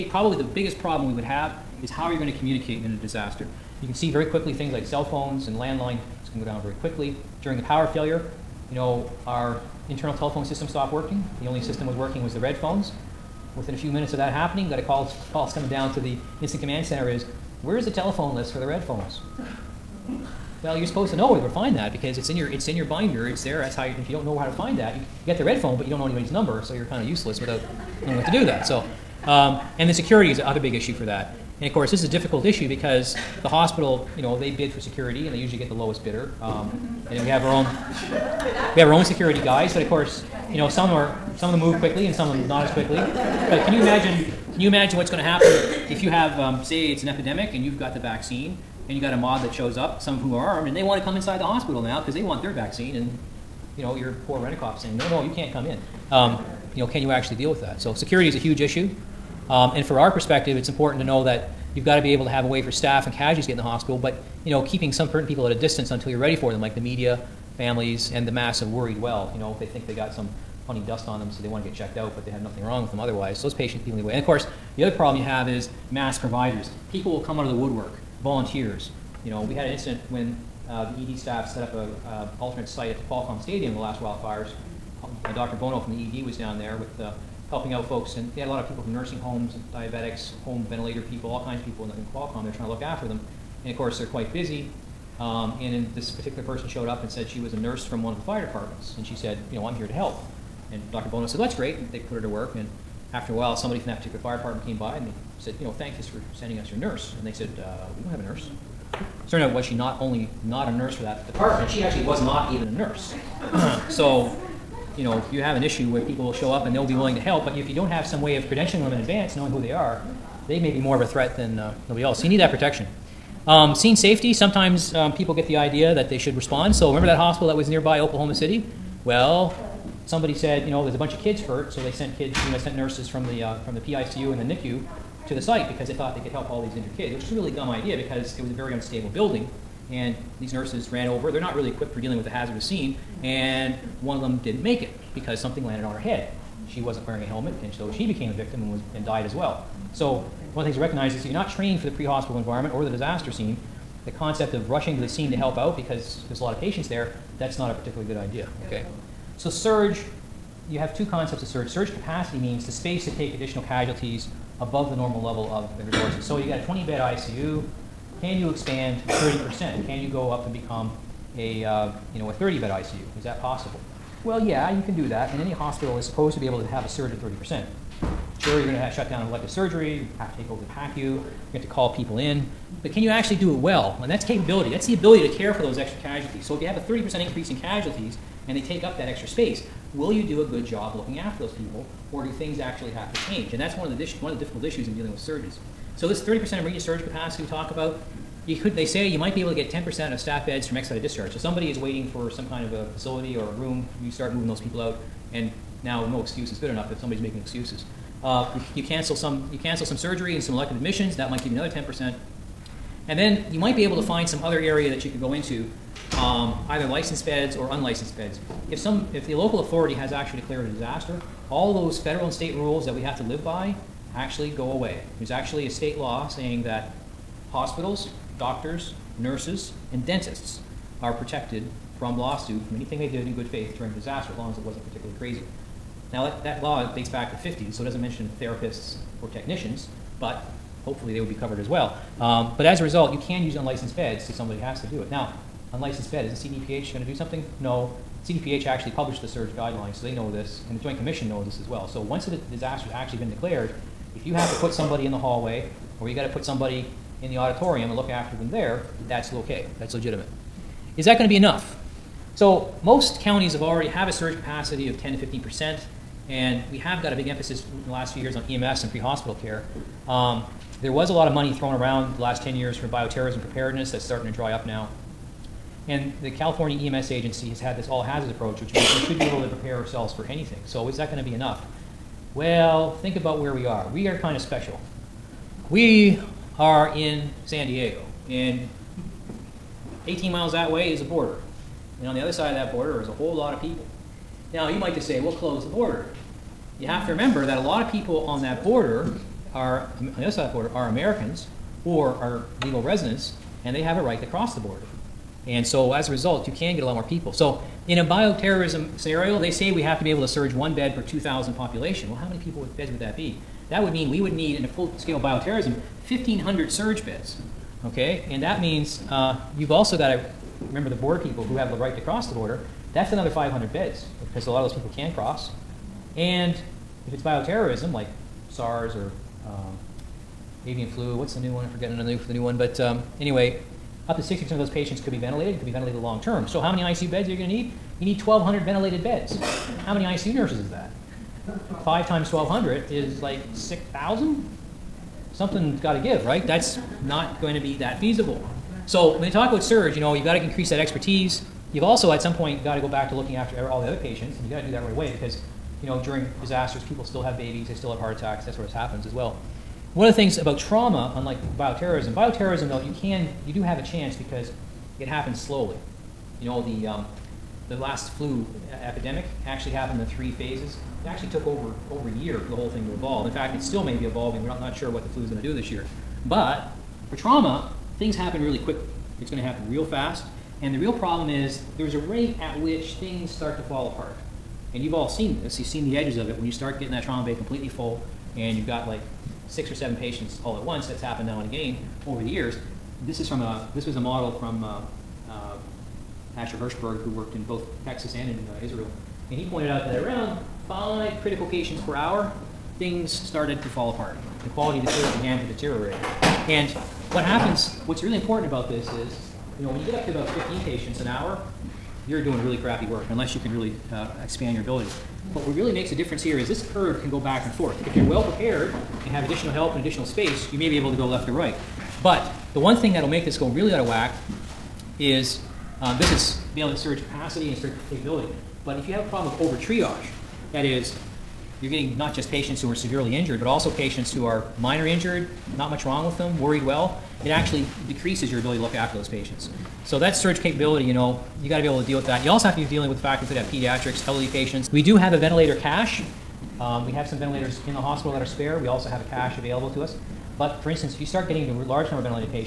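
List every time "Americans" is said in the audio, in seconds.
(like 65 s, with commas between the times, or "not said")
300 s.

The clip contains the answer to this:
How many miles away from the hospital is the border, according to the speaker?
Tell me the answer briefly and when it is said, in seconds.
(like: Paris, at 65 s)
18, at 290 s.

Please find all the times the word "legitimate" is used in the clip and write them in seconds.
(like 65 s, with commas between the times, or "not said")
259 s.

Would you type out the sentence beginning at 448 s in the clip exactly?
We also have a cache available to us.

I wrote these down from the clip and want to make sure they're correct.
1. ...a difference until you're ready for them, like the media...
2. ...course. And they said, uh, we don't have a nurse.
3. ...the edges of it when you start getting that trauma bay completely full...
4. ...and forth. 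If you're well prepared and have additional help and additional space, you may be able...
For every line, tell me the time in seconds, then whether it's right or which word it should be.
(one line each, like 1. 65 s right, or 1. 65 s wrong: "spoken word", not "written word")
1. 65 s wrong: "distance", not "difference"
2. 106 s wrong: "nurse", not "course"
3. 385 s right
4. 417 s right.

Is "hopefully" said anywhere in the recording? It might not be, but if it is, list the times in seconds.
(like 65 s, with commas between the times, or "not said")
240 s.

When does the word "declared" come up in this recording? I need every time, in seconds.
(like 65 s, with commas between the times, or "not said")
220 s, 253 s.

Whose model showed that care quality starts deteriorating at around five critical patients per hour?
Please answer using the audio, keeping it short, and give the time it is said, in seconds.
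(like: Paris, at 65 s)
Asher Hirshberg, at 396 s.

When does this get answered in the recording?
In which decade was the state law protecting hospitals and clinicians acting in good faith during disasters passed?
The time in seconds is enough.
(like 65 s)
237 s.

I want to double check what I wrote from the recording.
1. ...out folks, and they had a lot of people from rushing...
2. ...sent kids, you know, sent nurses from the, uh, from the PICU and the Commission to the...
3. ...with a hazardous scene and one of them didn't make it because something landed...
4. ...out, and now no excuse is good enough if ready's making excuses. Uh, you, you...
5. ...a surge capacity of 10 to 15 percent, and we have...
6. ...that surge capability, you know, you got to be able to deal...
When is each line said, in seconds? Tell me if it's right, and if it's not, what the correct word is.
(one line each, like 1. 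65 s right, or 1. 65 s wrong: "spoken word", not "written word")
1. 87 s wrong: "nursing", not "rushing"
2. 131 s wrong: "NICU", not "Commission"
3. 142 s right
4. 204 s wrong: "somebody", not "ready"
5. 264 s right
6. 439 s right.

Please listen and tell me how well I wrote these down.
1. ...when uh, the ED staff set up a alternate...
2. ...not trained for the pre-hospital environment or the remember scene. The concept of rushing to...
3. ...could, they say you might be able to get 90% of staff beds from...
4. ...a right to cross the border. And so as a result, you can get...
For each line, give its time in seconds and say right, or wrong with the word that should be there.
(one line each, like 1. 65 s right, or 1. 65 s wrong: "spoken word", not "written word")
1. 80 s right
2. 151 s wrong: "disaster", not "remember"
3. 198 s wrong: "10", not "90"
4. 303 s right.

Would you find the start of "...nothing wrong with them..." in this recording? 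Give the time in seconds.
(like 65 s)
72 s.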